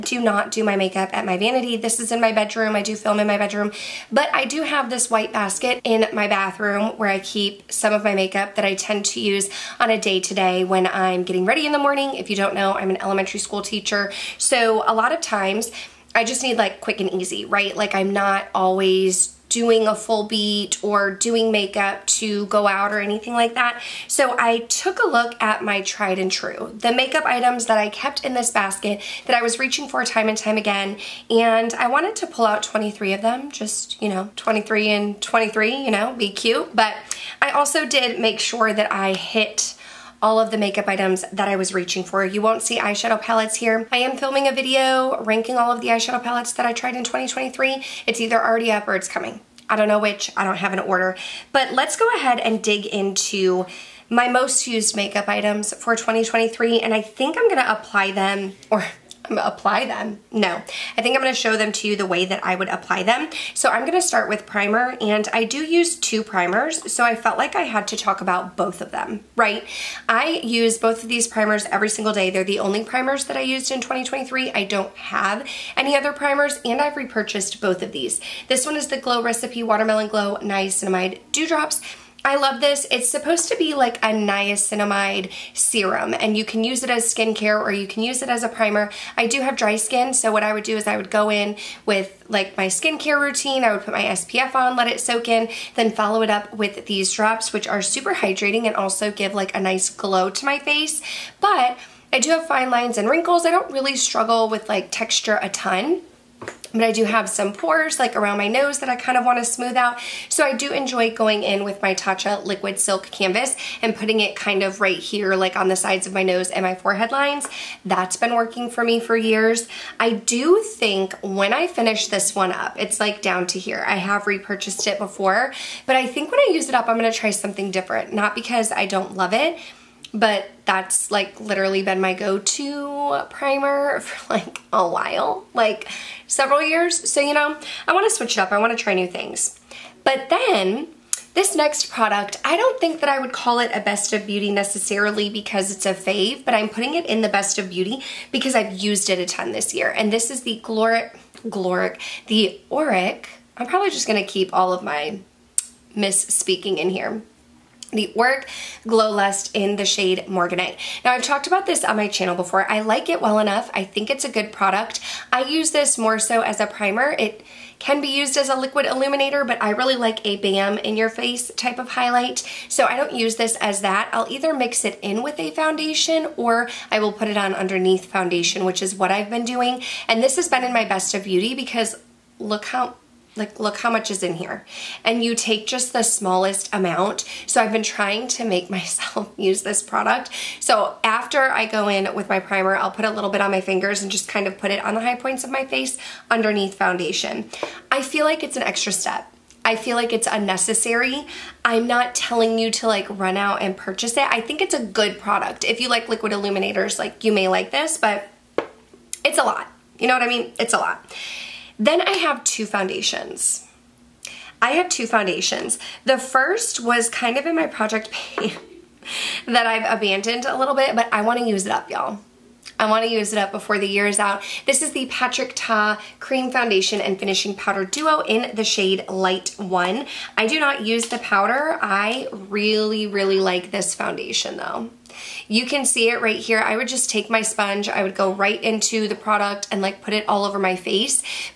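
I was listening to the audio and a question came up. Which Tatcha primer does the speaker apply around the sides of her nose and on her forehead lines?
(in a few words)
Liquid Silk Canvas.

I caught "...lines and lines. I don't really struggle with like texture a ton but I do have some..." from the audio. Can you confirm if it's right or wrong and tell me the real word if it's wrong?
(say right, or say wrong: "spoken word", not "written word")
wrong: "wrinkles", not "lines".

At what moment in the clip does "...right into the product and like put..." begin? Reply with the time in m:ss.
3:58.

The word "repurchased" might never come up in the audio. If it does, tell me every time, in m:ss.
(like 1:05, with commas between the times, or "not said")
1:16, 2:04.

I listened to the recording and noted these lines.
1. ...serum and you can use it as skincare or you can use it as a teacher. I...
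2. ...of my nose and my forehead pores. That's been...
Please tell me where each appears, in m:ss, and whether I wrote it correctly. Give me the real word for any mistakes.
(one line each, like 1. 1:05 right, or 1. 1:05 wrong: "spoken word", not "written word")
1. 1:25 wrong: "primer", not "teacher"
2. 1:56 wrong: "lines", not "pores".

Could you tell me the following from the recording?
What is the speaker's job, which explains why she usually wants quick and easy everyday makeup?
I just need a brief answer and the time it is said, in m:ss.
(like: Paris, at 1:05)
elementary school teacher, at 0:13.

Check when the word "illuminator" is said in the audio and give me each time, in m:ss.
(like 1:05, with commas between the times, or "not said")
2:48, 3:26.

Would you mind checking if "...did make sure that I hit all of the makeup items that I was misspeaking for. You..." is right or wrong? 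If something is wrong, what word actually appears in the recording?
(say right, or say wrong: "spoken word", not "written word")
wrong: "reaching", not "misspeaking".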